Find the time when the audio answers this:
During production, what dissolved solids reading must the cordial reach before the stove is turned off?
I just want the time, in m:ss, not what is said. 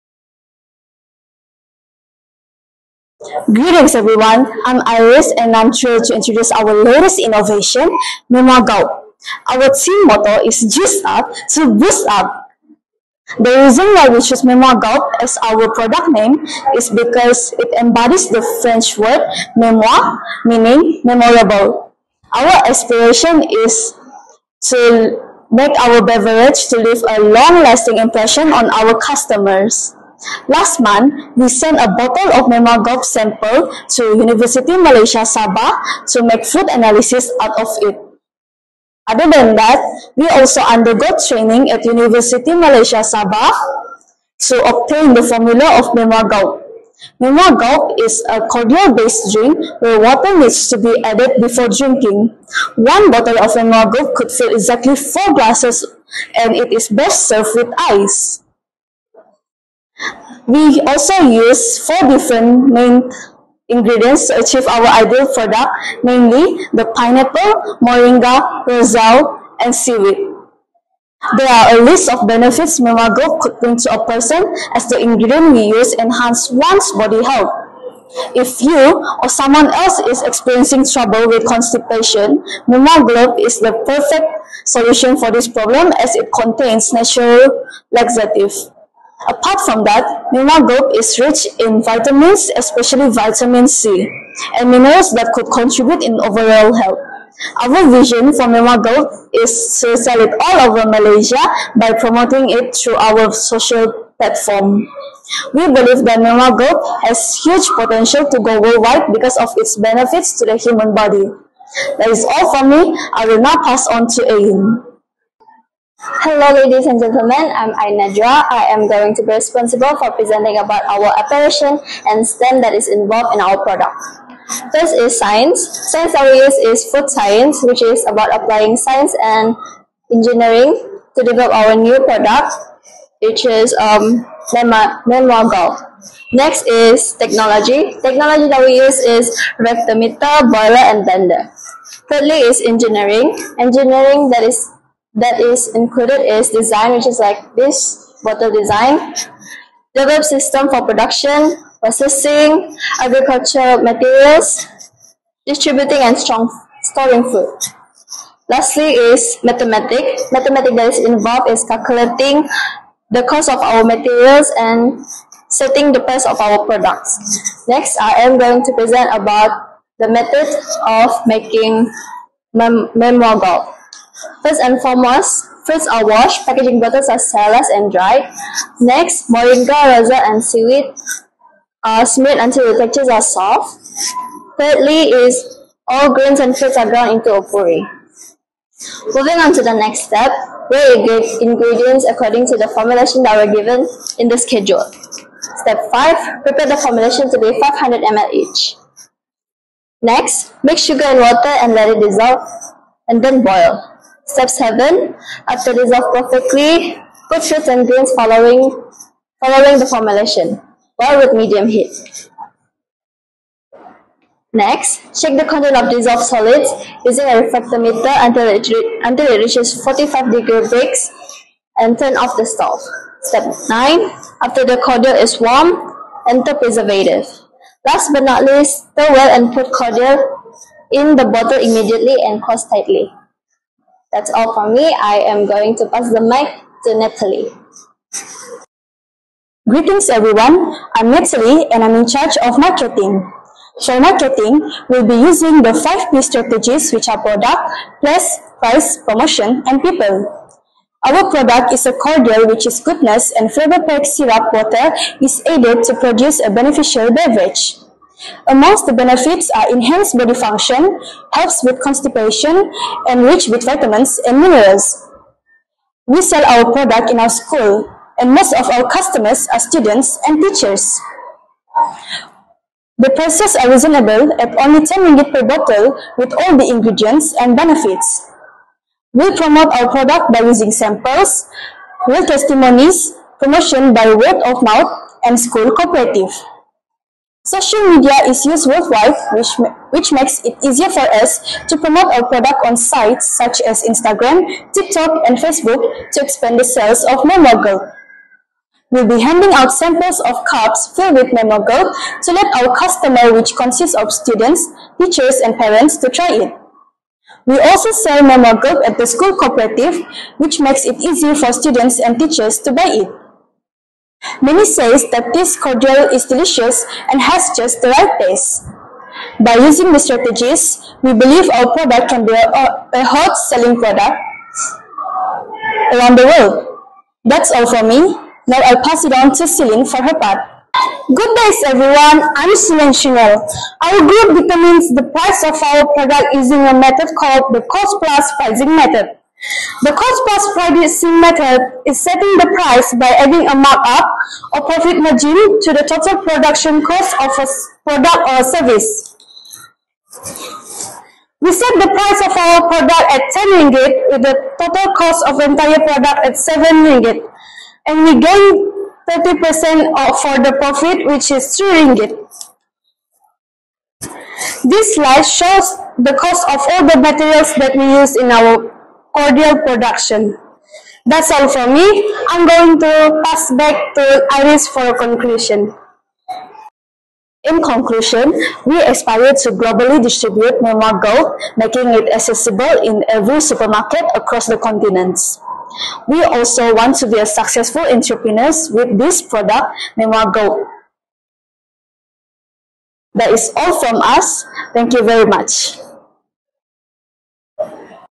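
3:39.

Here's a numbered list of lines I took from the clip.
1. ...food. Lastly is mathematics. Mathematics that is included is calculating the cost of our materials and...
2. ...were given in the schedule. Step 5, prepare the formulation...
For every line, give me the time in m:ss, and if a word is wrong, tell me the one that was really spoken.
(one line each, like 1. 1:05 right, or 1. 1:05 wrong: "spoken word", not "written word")
1. 2:37 wrong: "involved", not "included"
2. 3:13 right.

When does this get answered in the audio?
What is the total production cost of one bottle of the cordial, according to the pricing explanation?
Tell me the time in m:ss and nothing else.
5:56.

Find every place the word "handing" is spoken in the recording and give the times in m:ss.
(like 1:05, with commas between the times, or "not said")
4:59.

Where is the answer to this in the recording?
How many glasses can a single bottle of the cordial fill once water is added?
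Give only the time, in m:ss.
0:54.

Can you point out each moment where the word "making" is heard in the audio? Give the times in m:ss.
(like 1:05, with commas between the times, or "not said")
2:51, 6:21.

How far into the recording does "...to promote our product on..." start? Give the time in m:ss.
4:51.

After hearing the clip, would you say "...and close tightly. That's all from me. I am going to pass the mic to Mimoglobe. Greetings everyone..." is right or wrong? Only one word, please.
wrong.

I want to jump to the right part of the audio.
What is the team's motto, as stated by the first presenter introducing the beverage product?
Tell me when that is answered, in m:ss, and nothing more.
0:10.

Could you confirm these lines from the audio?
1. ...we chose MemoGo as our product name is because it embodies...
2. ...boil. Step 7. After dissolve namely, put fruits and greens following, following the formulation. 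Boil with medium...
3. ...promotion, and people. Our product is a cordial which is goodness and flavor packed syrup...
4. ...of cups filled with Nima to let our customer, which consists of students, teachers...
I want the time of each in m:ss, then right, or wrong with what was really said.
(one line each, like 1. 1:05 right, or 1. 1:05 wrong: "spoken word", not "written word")
1. 0:14 right
2. 3:23 wrong: "perfectly", not "namely"
3. 4:08 right
4. 5:00 wrong: "Memogirl", not "Nima".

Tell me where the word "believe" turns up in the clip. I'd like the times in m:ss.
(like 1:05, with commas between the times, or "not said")
1:45, 5:21.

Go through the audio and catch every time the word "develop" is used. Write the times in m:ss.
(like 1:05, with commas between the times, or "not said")
2:11, 2:29.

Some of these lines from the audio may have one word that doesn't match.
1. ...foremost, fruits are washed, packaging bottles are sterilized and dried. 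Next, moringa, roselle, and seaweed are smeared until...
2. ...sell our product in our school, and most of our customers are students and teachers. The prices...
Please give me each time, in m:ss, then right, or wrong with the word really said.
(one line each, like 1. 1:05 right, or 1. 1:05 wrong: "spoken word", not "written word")
1. 2:54 right
2. 4:26 right.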